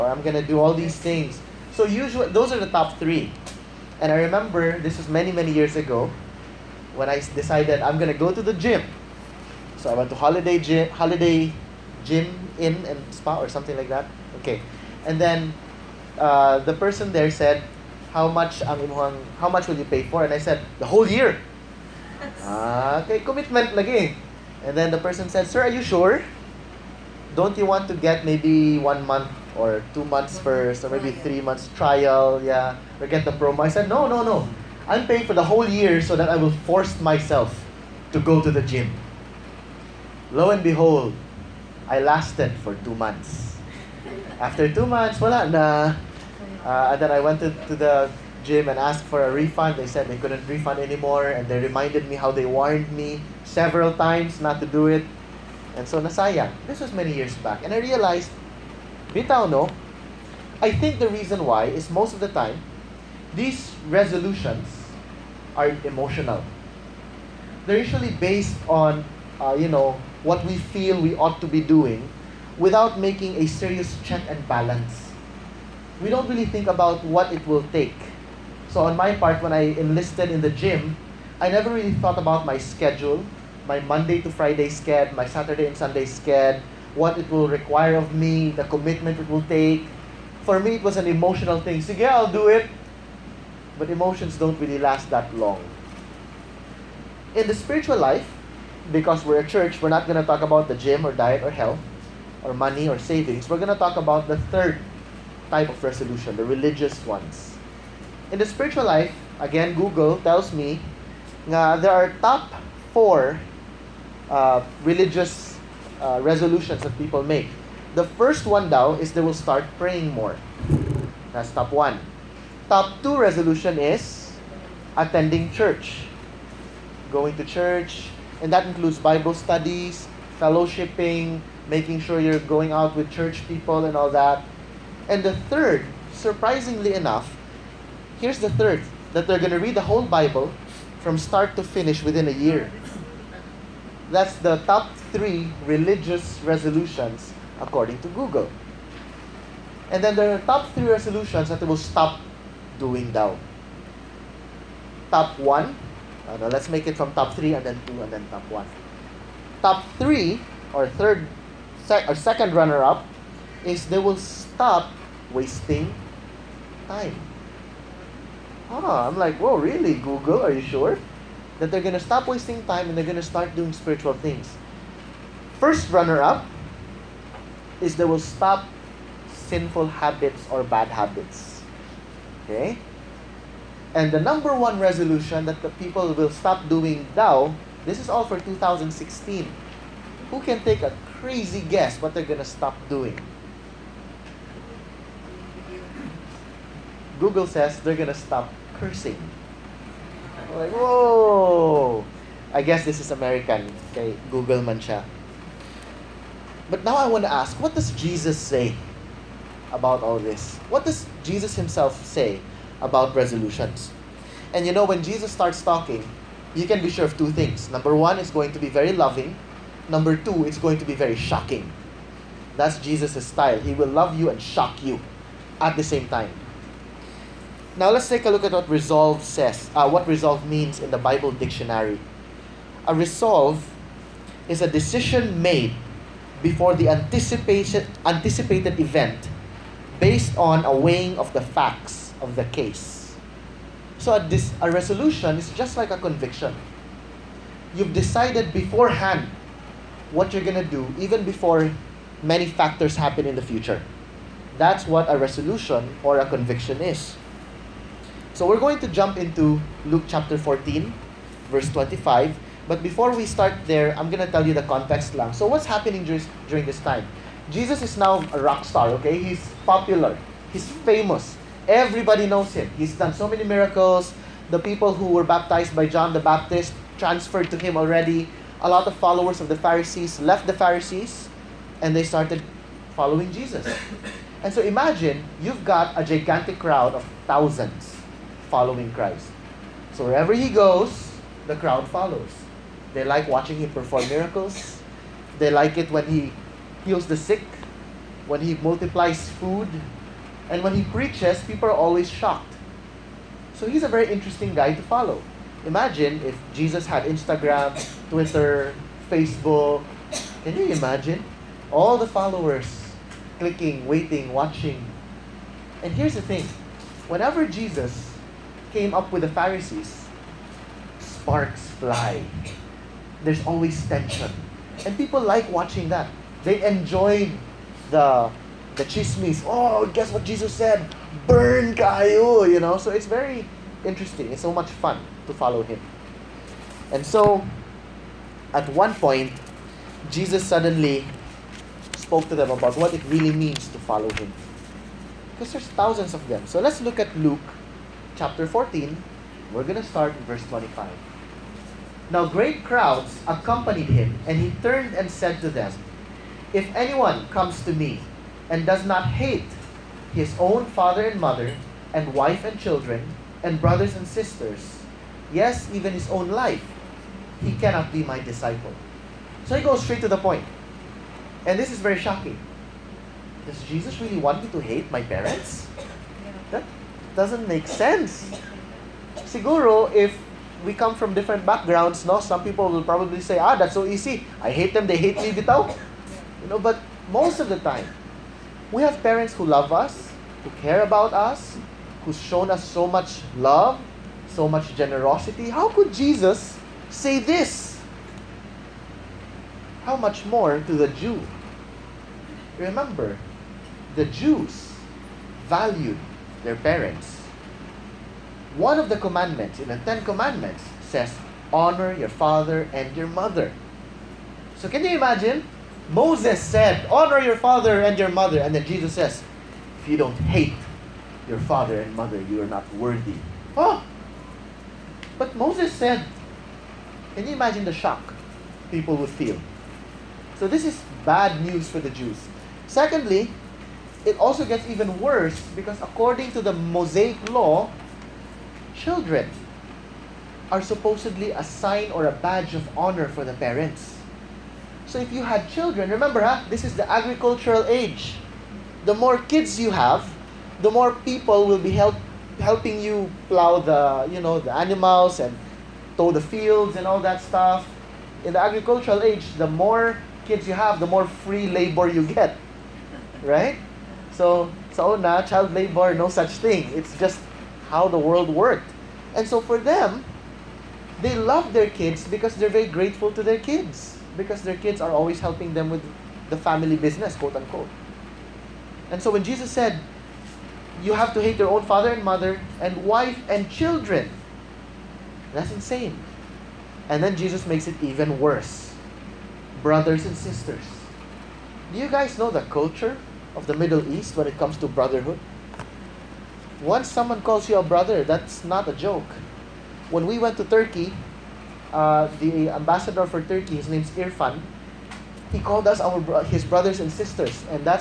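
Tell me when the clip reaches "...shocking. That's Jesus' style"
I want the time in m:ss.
3:41.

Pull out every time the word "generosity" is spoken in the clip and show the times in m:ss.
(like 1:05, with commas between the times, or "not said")
6:34.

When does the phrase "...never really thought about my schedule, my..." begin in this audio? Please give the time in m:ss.
1:21.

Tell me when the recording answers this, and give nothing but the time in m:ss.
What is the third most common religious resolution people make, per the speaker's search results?
2:19.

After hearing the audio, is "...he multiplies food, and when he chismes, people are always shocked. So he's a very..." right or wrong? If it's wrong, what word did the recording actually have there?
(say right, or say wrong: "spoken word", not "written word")
wrong: "preaches", not "chismes".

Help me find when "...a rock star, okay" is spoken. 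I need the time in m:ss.
4:28.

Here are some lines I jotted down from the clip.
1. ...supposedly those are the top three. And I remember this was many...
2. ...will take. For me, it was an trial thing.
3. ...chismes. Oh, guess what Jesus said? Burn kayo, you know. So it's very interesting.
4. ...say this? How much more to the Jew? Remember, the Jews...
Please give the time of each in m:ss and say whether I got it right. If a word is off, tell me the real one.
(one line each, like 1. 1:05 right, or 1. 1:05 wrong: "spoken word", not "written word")
1. 0:01 wrong: "usually", not "supposedly"
2. 1:29 wrong: "emotional", not "trial"
3. 5:28 right
4. 6:36 right.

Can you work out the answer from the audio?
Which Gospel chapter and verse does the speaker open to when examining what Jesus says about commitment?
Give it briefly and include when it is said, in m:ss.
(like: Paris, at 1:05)
Luke 14:25, at 4:19.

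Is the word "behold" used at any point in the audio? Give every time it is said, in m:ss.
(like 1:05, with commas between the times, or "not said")
0:40.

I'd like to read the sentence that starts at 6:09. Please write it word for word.
So he goes straight to the point.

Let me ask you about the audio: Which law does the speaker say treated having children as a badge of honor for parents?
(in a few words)
Mosaic law.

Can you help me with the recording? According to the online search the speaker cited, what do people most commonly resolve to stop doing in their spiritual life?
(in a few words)
Cursing.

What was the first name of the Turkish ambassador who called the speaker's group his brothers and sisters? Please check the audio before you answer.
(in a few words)
Irfan.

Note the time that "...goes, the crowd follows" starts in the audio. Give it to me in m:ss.
4:50.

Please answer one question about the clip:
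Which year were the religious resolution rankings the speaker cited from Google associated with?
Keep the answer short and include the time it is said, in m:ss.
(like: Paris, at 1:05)
2016, at 3:08.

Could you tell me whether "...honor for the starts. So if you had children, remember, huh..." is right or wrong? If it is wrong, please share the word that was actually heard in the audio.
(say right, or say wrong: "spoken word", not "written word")
wrong: "parents", not "starts".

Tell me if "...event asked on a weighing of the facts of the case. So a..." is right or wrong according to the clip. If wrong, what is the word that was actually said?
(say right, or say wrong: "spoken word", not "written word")
wrong: "based", not "asked".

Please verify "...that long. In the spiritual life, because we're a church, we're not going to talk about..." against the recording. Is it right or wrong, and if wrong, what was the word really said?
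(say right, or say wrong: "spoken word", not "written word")
right.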